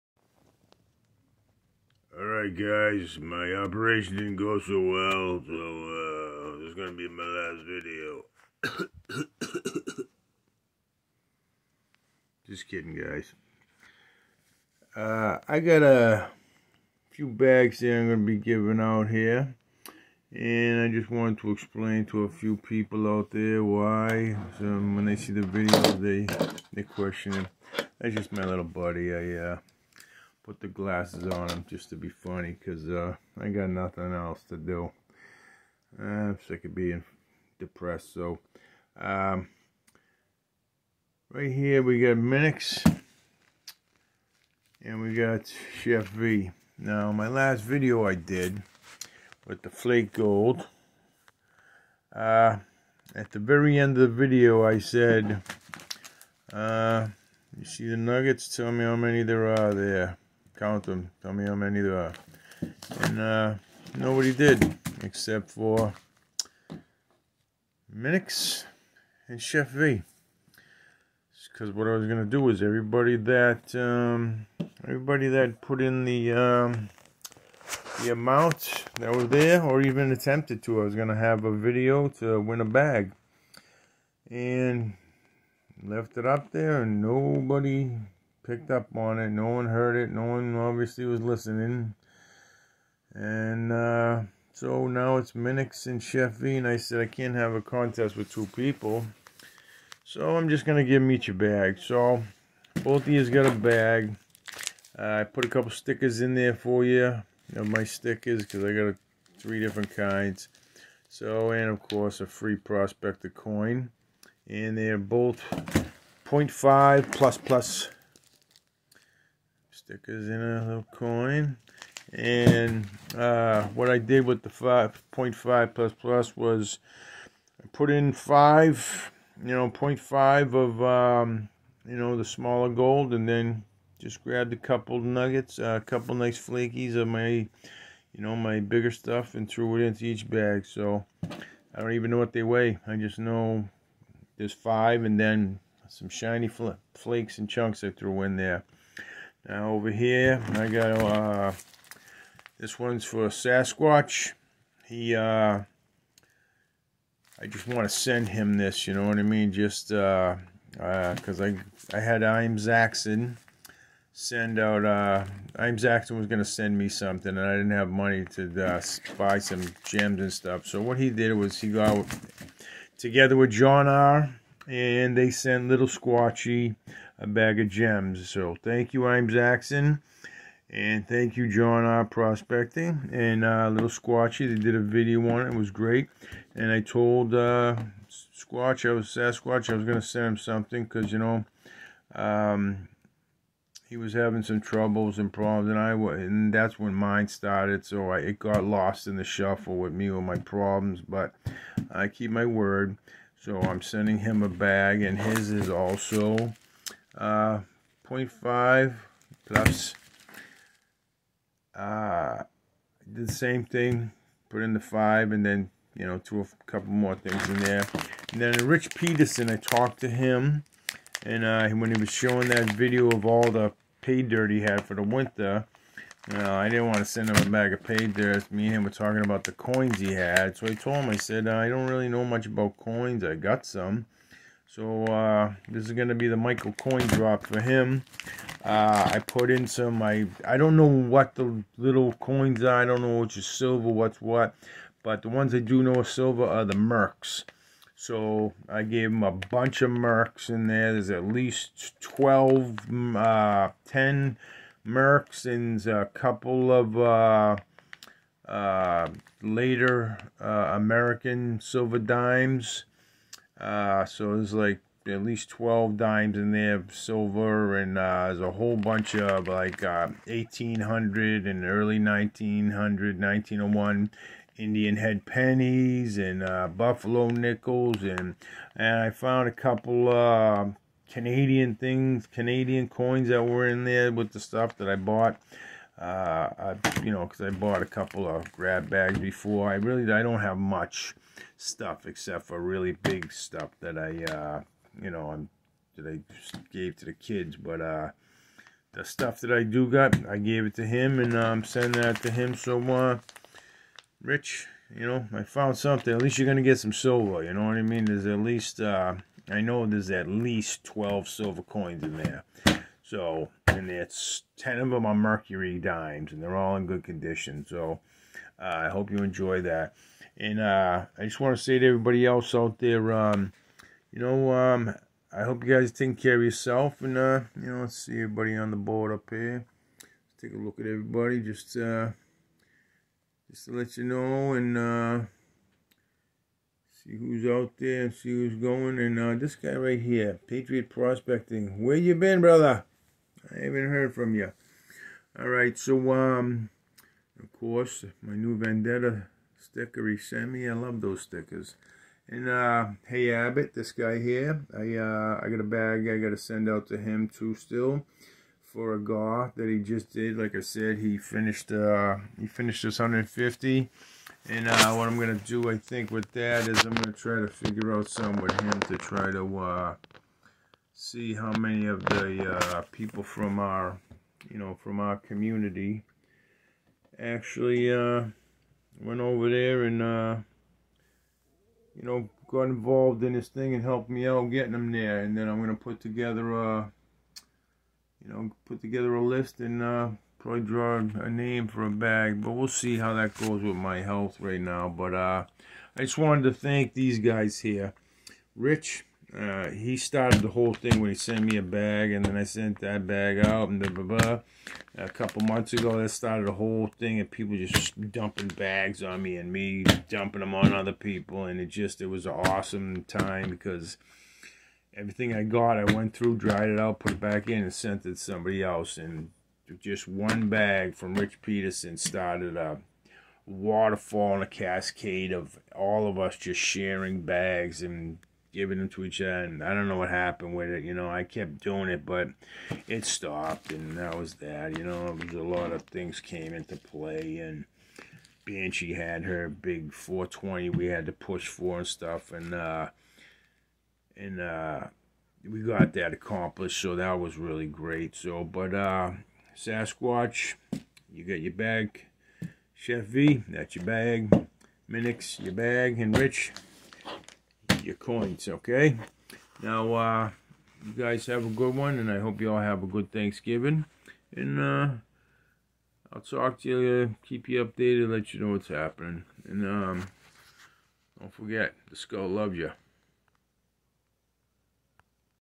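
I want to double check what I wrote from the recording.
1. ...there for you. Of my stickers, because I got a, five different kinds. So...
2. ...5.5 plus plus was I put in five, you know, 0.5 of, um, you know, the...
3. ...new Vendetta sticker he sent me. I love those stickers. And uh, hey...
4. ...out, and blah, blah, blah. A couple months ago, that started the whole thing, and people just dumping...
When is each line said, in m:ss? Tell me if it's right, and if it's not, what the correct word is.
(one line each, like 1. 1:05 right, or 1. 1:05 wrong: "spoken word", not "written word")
1. 1:46 wrong: "three", not "five"
2. 2:04 right
3. 5:48 right
4. 6:43 right.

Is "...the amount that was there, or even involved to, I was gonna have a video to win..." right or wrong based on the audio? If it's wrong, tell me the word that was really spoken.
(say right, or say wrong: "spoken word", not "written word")
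wrong: "attempted", not "involved".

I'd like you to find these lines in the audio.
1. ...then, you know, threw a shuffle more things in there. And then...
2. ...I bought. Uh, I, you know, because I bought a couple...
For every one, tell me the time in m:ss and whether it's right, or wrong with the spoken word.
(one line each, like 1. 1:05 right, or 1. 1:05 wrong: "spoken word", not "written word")
1. 3:35 wrong: "couple", not "shuffle"
2. 4:44 right.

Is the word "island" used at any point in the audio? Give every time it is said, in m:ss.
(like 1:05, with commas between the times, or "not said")
not said.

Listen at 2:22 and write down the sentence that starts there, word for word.
I just know there's five and then some shiny fl flakes and chunks I threw in there.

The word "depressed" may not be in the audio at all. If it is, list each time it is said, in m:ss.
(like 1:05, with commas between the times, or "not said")
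0:37.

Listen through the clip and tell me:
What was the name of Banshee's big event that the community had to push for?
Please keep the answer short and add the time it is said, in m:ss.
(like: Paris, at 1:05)
420, at 7:19.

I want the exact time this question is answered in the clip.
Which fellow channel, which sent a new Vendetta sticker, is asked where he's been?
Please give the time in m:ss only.
5:40.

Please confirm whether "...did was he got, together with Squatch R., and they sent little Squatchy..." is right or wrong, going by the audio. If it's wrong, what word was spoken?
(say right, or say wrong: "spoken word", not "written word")
wrong: "John", not "Squatch".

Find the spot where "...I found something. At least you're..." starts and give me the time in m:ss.
5:05.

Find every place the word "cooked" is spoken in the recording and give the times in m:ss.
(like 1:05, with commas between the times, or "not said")
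not said.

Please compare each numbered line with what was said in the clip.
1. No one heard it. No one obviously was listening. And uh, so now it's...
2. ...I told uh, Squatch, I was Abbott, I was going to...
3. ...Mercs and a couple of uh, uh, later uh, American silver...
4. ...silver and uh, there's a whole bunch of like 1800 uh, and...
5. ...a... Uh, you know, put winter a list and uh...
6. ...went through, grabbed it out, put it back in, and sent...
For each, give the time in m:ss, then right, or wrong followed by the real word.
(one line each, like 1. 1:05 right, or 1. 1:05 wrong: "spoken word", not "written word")
1. 1:29 right
2. 3:06 wrong: "Sasquatch", not "Abbott"
3. 4:14 right
4. 4:26 right
5. 6:26 wrong: "together", not "winter"
6. 6:55 wrong: "dried", not "grabbed".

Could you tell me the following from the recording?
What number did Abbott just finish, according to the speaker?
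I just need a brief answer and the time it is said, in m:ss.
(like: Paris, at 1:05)
150, at 6:02.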